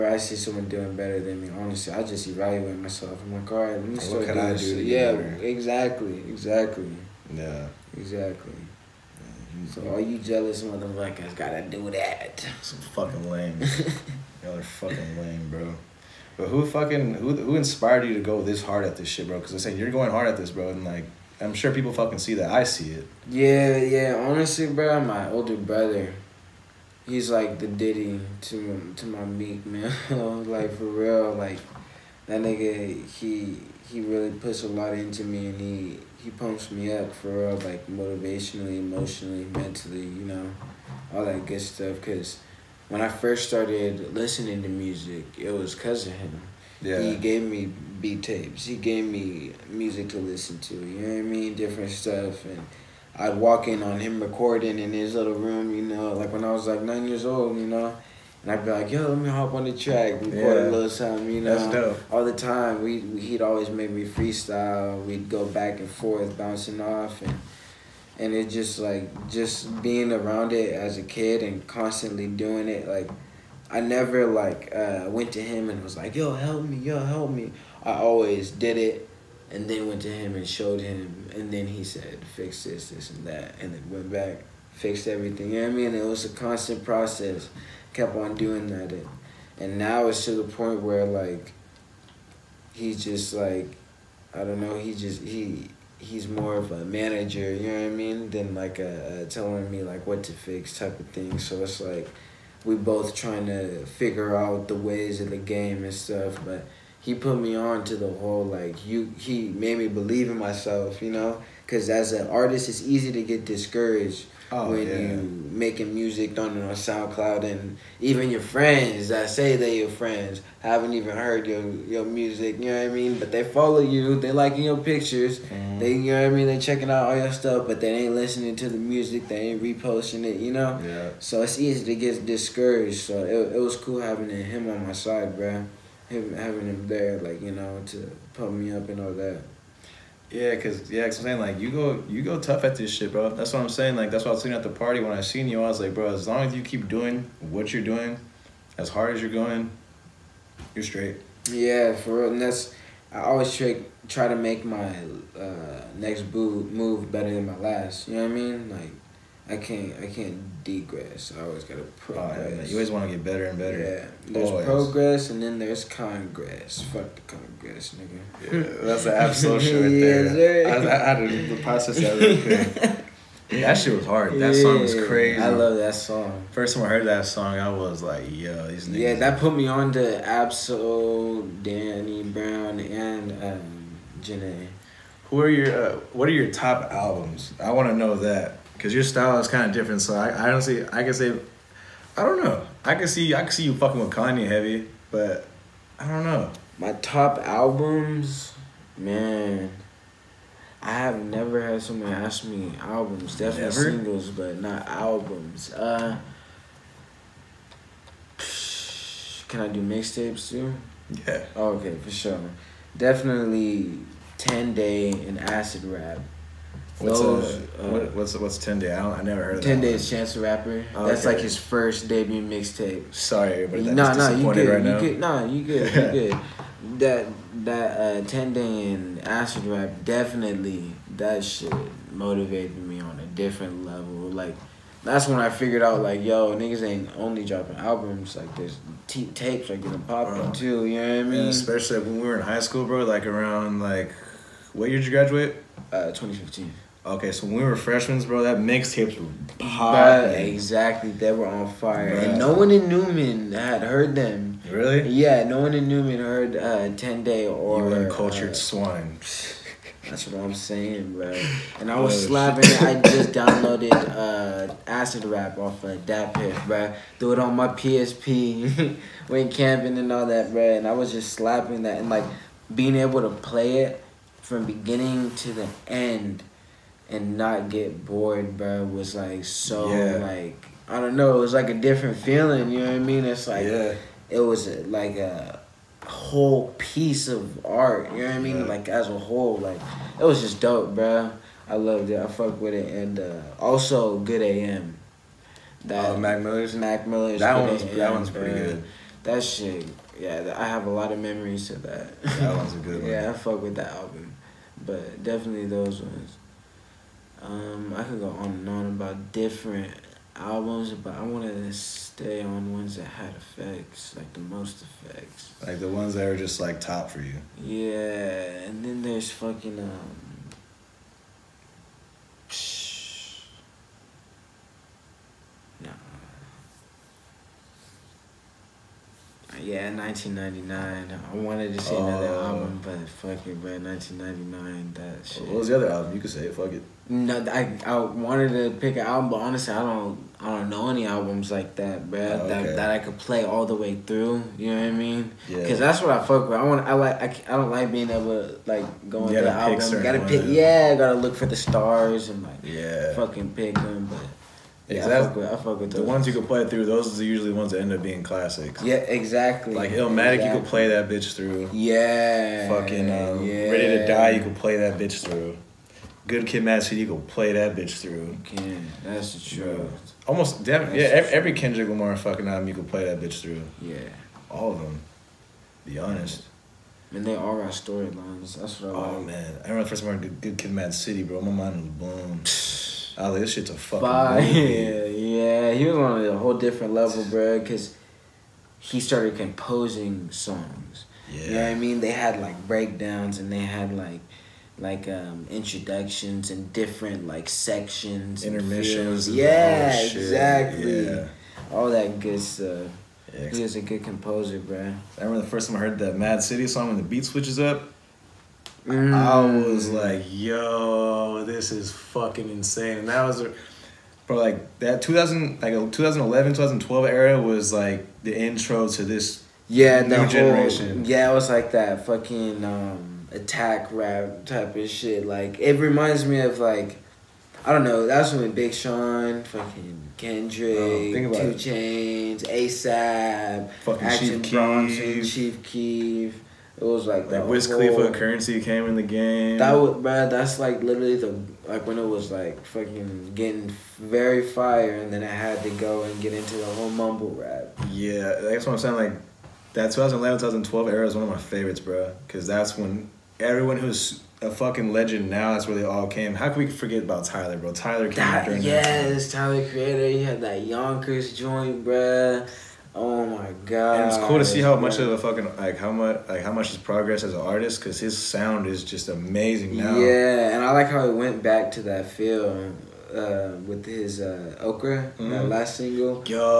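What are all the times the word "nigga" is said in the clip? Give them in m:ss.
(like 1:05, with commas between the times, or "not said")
0:32, 2:47, 2:58, 3:56.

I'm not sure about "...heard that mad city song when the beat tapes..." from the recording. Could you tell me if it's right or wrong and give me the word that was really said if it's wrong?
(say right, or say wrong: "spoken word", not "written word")
wrong: "switches", not "tapes".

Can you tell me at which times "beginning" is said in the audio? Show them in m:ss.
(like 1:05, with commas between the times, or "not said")
4:34.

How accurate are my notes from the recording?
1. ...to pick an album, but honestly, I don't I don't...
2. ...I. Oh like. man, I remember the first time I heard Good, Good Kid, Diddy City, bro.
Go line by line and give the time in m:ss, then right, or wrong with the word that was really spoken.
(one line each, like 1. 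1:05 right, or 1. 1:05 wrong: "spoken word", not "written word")
1. 5:38 right
2. 6:18 wrong: "Mad", not "Diddy".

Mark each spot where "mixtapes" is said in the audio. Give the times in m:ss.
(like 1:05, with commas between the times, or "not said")
3:29, 3:42, 4:08.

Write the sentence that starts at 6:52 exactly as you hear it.
And that was, bro, like that 2000, like 2011, 2012 era was like the intro to this yeah, new generation.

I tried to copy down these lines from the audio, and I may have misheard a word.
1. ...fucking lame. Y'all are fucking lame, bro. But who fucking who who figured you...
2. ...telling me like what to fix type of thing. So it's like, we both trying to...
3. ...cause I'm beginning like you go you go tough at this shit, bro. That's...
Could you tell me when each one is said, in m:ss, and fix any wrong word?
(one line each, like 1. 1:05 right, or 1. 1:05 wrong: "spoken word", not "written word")
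1. 0:12 wrong: "inspired", not "figured"
2. 1:39 right
3. 2:21 wrong: "saying", not "beginning".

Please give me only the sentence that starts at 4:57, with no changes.
That one's AM, that one's pretty bro.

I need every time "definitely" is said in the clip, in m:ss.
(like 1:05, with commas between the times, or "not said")
3:23, 3:32, 3:50, 5:05.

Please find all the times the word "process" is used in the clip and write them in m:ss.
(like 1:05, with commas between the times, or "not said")
1:26, 2:51.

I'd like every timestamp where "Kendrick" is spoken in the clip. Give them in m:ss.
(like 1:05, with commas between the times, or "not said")
6:11, 7:10.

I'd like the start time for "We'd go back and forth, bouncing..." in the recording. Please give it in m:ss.
1:05.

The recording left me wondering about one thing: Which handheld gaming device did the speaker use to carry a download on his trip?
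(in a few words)
PSP.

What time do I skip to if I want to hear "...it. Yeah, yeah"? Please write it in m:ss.
0:22.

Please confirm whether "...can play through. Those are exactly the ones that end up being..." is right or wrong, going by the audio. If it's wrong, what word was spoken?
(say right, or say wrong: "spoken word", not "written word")
wrong: "usually", not "exactly".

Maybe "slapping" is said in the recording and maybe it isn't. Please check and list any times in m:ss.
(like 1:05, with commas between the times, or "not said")
4:22, 4:31.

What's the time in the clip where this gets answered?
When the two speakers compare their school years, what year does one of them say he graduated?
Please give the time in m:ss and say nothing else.
4:06.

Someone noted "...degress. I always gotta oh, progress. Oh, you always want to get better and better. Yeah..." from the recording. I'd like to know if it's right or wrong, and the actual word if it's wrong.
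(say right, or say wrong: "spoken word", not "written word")
right.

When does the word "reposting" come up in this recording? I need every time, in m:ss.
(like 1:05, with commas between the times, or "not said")
2:09.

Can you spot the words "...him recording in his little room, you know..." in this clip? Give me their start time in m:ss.
0:53.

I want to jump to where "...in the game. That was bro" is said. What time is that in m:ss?
7:18.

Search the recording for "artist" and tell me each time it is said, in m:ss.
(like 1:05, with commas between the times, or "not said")
1:52, 7:47.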